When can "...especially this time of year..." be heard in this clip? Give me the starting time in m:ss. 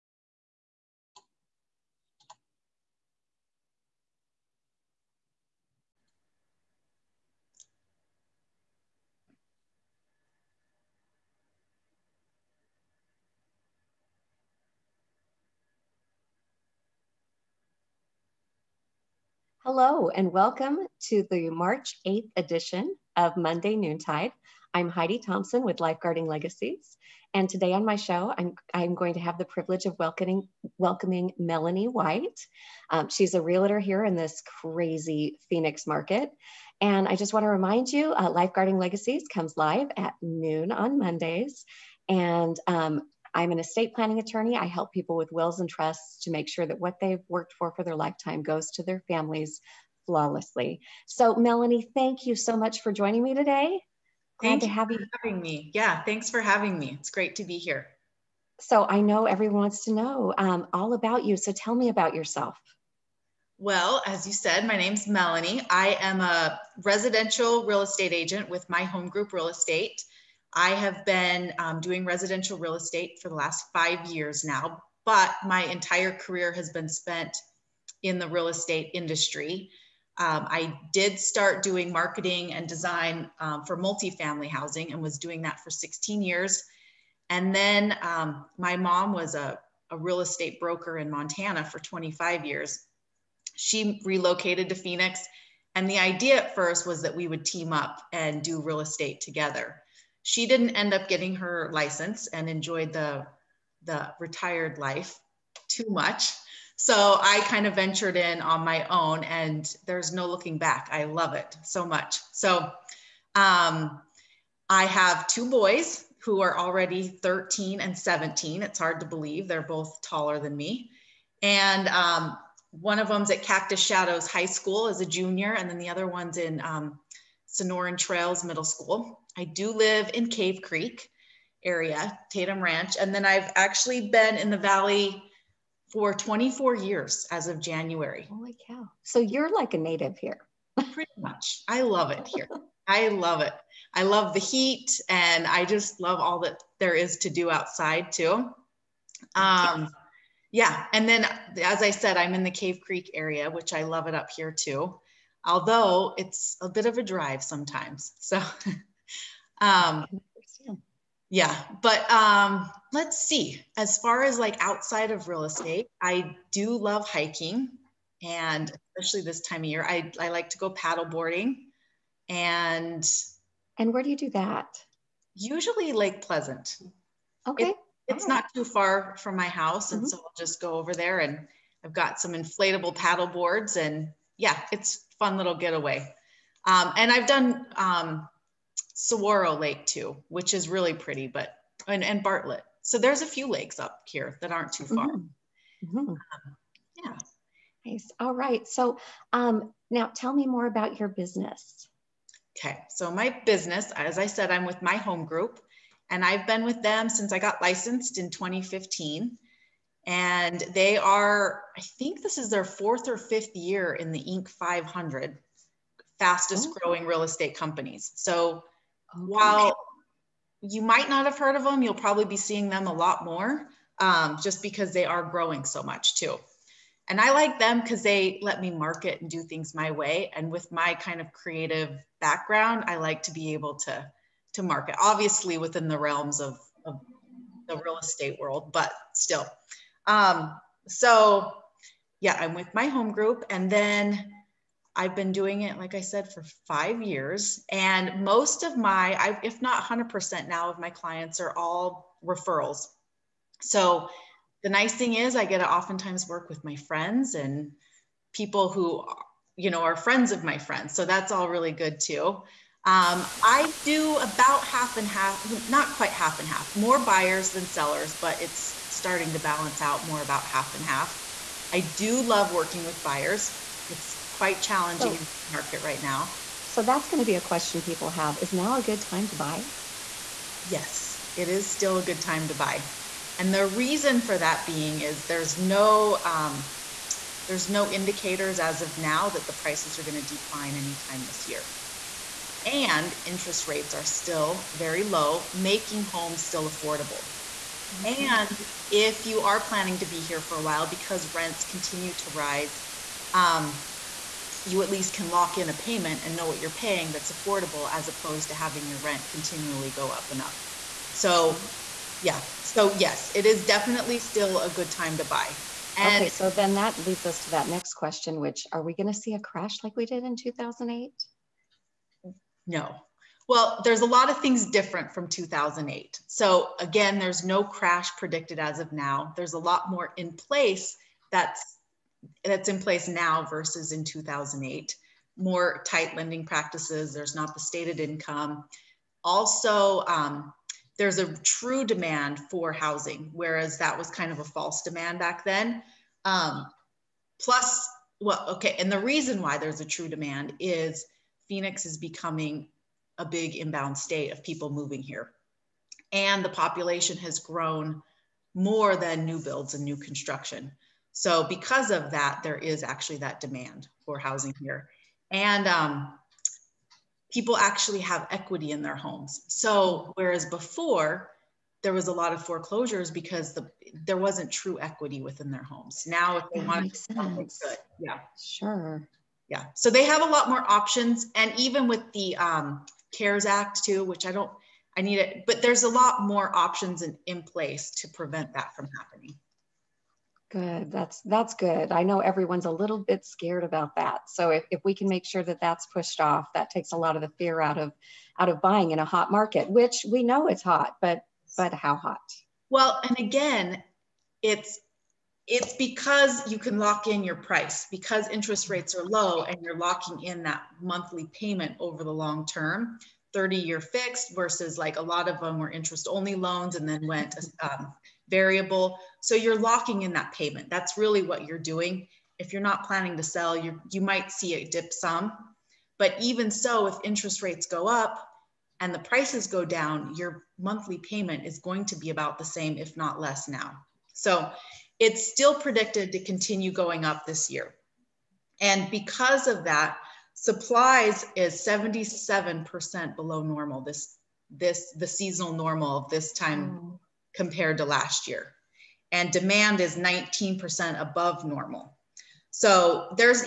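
2:48.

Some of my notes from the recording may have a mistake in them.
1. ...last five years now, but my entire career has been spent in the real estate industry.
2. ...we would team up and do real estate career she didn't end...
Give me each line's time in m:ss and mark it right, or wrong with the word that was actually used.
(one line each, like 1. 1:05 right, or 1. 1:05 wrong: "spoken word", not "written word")
1. 1:13 right
2. 1:37 wrong: "together", not "career".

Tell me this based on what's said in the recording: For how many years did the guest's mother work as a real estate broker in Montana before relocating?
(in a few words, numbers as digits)
25.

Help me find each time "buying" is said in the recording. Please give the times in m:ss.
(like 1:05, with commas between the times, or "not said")
6:38.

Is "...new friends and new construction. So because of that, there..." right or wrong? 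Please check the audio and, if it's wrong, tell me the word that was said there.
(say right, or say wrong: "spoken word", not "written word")
wrong: "builds", not "friends".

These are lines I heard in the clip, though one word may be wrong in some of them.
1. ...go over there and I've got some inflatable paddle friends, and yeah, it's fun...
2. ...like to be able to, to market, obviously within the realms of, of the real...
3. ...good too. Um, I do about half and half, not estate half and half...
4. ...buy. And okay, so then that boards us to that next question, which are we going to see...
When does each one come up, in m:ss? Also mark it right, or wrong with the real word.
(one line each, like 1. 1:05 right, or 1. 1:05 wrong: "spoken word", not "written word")
1. 3:00 wrong: "boards", not "friends"
2. 3:52 right
3. 4:21 wrong: "quite", not "estate"
4. 5:15 wrong: "leads", not "boards".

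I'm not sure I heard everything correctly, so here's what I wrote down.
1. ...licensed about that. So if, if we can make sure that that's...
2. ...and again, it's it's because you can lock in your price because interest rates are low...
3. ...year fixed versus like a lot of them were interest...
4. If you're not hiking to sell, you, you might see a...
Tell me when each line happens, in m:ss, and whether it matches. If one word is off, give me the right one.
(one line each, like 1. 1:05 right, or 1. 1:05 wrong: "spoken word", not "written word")
1. 6:33 wrong: "scared", not "licensed"
2. 6:43 right
3. 6:53 right
4. 7:02 wrong: "planning", not "hiking".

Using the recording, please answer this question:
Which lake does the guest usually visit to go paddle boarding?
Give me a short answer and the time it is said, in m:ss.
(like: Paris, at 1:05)
Lake Pleasant, at 2:55.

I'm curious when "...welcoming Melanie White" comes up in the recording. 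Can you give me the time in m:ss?
0:30.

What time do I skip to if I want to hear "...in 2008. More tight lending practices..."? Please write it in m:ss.
5:33.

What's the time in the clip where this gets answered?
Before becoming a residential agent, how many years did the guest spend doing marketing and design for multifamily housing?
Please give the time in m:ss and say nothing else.
1:25.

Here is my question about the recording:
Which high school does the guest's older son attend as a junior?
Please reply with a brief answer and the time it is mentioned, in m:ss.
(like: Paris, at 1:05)
Cactus Shadows High School, at 2:03.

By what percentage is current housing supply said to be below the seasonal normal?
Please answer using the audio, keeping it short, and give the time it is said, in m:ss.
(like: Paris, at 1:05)
77%, at 7:21.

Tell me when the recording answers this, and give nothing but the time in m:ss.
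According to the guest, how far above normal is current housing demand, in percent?
7:29.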